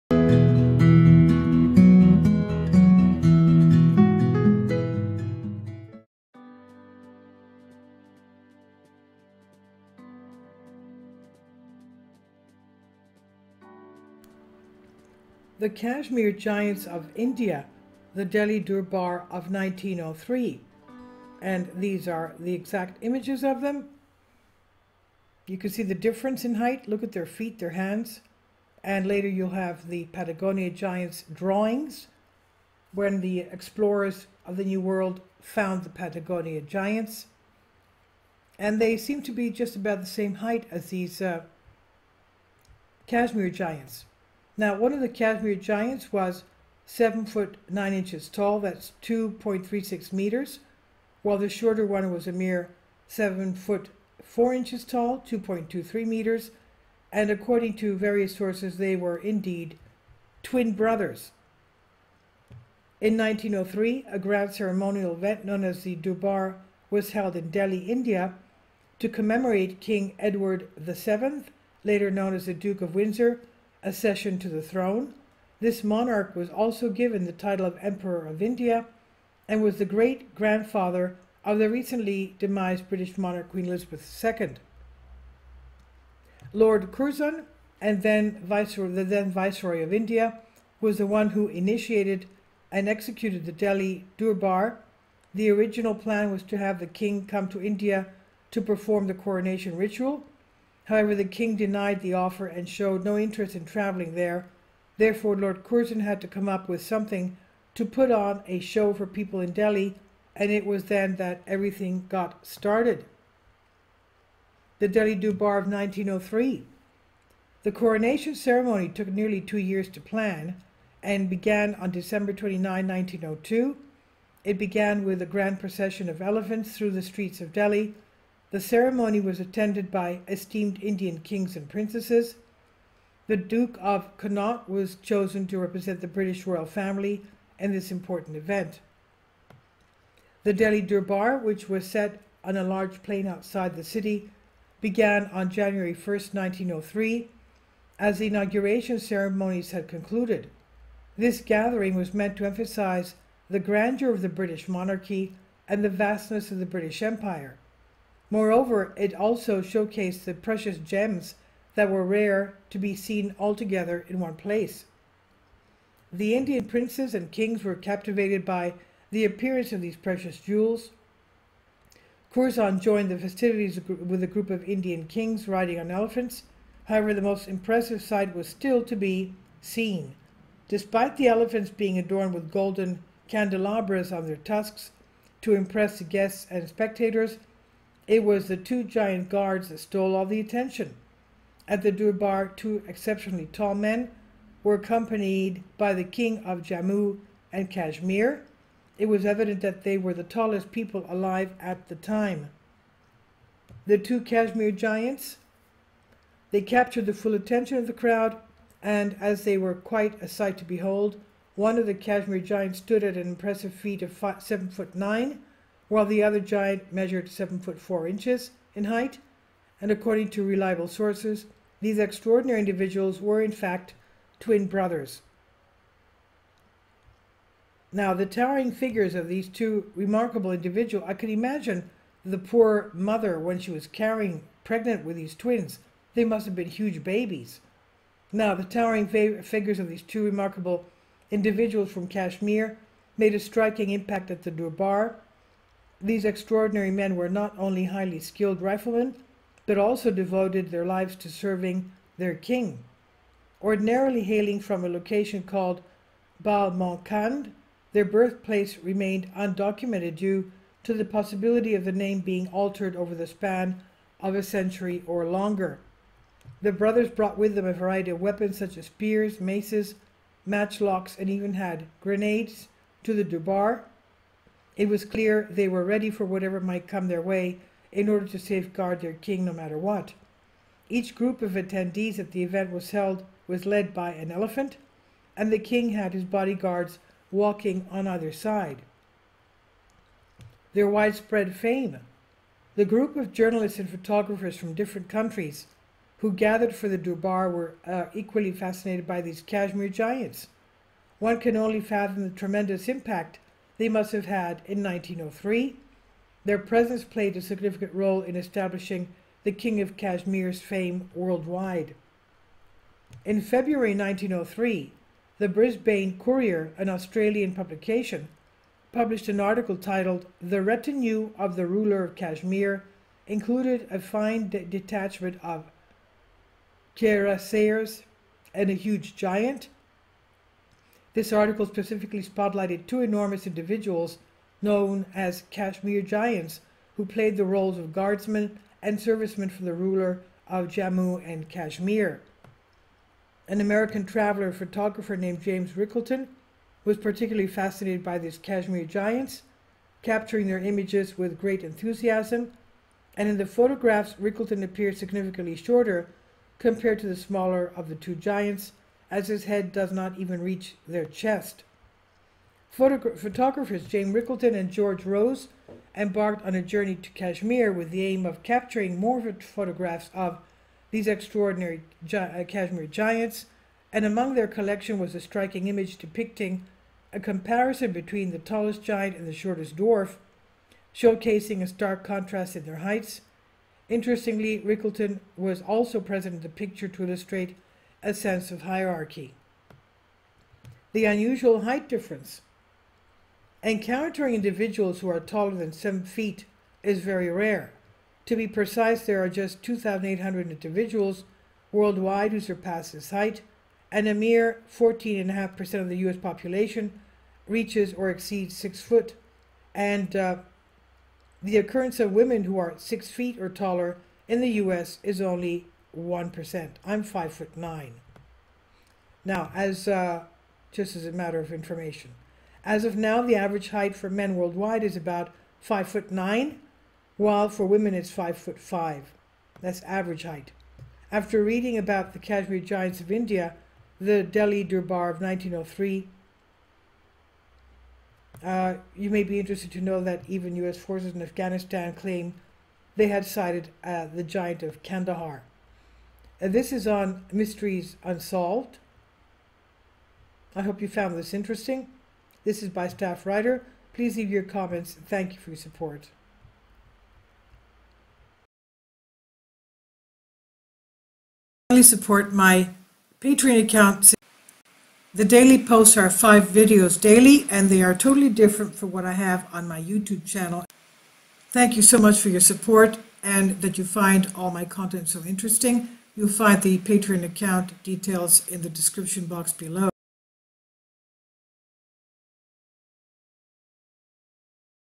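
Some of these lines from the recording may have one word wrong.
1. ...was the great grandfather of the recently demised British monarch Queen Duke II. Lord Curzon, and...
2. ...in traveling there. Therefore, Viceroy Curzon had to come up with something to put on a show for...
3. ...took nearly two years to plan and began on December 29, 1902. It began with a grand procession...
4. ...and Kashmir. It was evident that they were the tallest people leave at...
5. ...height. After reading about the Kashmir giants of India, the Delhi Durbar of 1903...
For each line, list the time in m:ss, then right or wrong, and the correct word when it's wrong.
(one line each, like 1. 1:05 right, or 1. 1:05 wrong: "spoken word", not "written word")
1. 1:19 wrong: "Elizabeth", not "Duke"
2. 1:43 wrong: "Lord", not "Viceroy"
3. 1:58 right
4. 3:17 wrong: "alive", not "leave"
5. 7:10 right.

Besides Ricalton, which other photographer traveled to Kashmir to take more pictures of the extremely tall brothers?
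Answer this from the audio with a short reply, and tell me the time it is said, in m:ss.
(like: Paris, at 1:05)
George Rose, at 6:04.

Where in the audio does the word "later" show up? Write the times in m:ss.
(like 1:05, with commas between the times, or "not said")
0:29, 1:11.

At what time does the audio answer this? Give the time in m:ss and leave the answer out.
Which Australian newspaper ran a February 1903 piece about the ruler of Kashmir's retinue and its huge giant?
5:15.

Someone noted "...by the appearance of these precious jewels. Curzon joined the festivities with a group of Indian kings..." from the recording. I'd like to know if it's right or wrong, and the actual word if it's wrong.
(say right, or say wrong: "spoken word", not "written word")
right.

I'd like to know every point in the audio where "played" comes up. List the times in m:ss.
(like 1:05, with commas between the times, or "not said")
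5:07, 5:37.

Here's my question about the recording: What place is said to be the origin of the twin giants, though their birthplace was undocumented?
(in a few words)
Balmankand.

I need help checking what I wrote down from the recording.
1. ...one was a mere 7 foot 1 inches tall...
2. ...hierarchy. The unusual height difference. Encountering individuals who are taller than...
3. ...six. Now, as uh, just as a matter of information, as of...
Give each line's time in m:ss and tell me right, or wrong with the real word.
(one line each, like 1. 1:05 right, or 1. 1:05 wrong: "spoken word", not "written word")
1. 0:51 wrong: "4", not "1"
2. 6:28 right
3. 6:57 wrong: "nine", not "six".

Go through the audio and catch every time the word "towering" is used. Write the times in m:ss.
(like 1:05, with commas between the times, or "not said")
3:48, 3:58.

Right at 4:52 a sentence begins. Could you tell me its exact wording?
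The group of journalists and photographers from different countries who gathered for the Durbar were uh, equally fascinated by these Kashmir giants.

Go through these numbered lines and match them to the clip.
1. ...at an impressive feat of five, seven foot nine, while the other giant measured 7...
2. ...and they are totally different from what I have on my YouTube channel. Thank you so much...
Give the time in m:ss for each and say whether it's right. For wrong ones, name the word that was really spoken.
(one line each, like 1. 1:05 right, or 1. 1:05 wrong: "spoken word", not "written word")
1. 3:33 right
2. 7:47 right.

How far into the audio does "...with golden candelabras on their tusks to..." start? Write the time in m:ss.
3:02.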